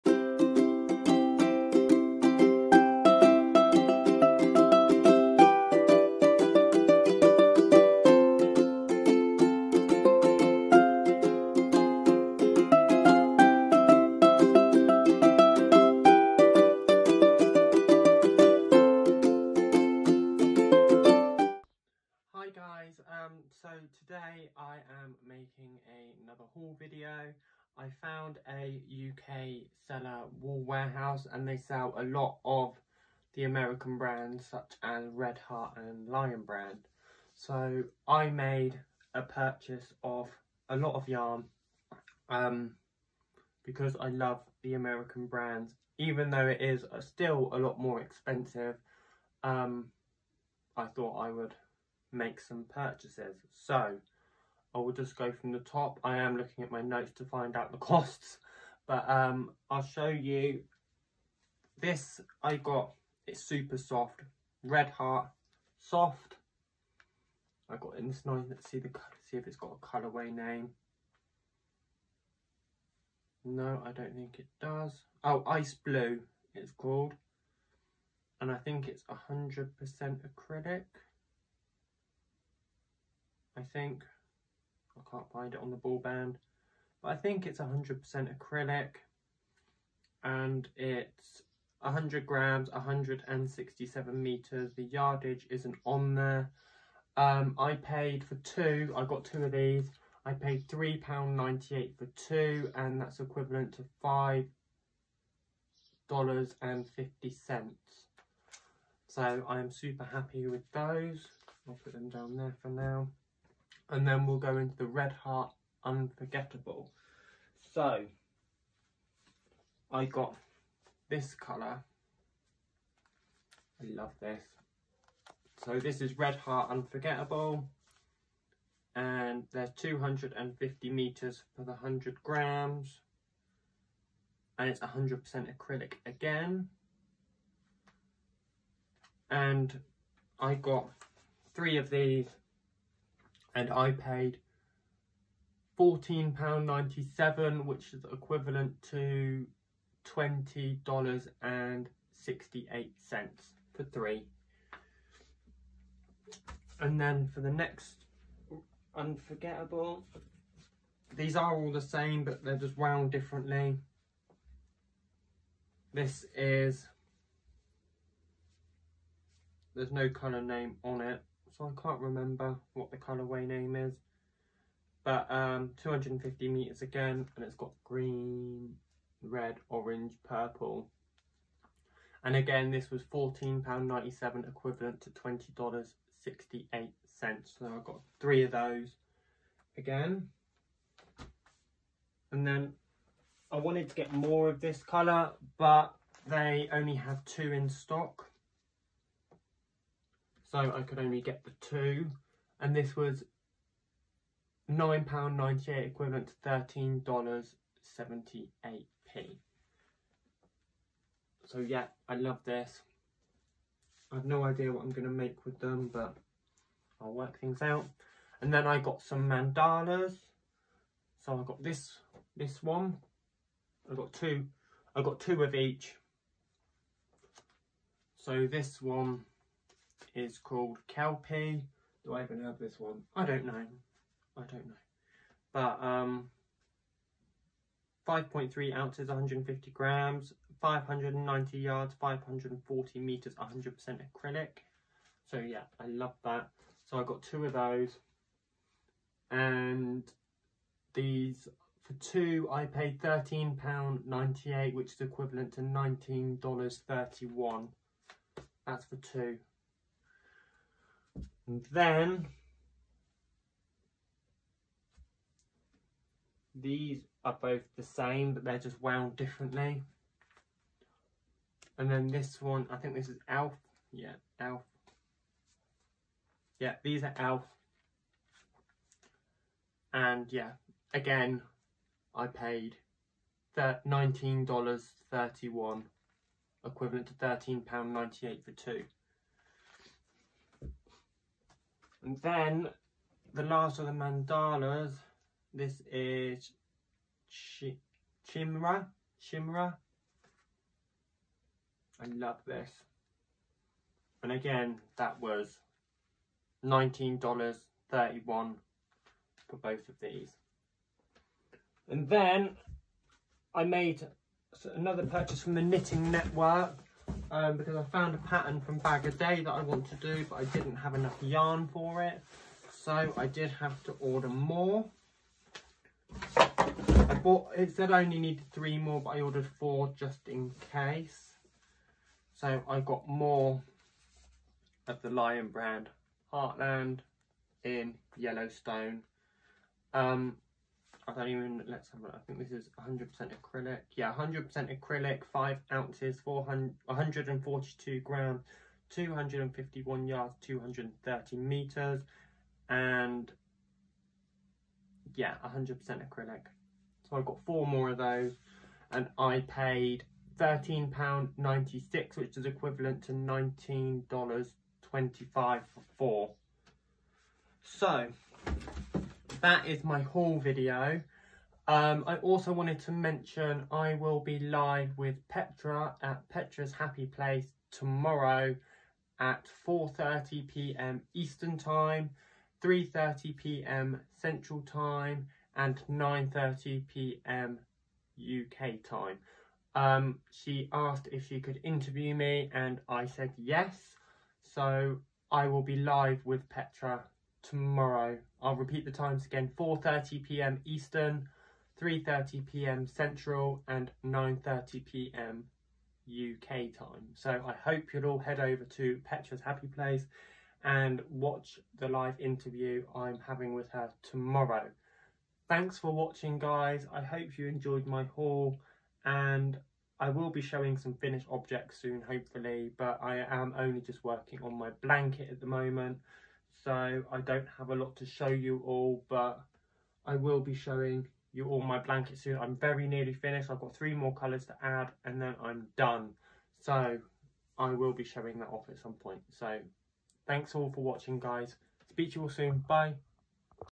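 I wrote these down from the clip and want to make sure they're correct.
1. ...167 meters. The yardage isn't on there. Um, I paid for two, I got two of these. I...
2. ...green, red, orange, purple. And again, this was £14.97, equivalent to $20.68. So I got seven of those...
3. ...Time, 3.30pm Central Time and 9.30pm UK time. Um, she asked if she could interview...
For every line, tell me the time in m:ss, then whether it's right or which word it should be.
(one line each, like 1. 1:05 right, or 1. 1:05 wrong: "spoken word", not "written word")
1. 1:32 right
2. 2:57 wrong: "three", not "seven"
3. 6:21 right.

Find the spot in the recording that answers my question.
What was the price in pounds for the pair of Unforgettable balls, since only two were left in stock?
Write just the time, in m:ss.
3:24.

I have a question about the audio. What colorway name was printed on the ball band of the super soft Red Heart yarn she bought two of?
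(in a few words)
Ice blue.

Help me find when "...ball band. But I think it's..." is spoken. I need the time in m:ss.
1:25.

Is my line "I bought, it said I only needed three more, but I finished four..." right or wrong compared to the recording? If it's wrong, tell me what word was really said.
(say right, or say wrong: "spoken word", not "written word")
wrong: "ordered", not "finished".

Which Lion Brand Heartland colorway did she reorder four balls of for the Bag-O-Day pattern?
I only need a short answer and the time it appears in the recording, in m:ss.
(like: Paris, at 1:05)
Yellowstone, at 5:38.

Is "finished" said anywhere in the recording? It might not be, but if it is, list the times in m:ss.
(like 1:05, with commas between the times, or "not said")
7:00, 7:13.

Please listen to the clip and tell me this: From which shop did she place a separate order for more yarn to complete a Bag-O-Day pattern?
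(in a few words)
Knitting Network.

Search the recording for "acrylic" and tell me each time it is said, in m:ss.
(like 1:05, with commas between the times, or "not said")
1:20, 1:28, 2:15, 4:04.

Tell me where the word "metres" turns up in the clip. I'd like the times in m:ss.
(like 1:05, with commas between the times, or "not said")
2:10, 2:56.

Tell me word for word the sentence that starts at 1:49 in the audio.
So I'm super happy with those.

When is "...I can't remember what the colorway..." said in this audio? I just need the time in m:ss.
2:51.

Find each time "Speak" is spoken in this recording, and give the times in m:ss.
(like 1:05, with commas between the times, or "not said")
7:21.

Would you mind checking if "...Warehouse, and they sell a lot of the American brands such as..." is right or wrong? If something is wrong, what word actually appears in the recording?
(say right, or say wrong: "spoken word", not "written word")
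right.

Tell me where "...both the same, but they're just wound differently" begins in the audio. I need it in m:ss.
4:27.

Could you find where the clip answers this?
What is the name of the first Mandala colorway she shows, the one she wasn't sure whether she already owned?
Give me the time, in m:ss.
3:50.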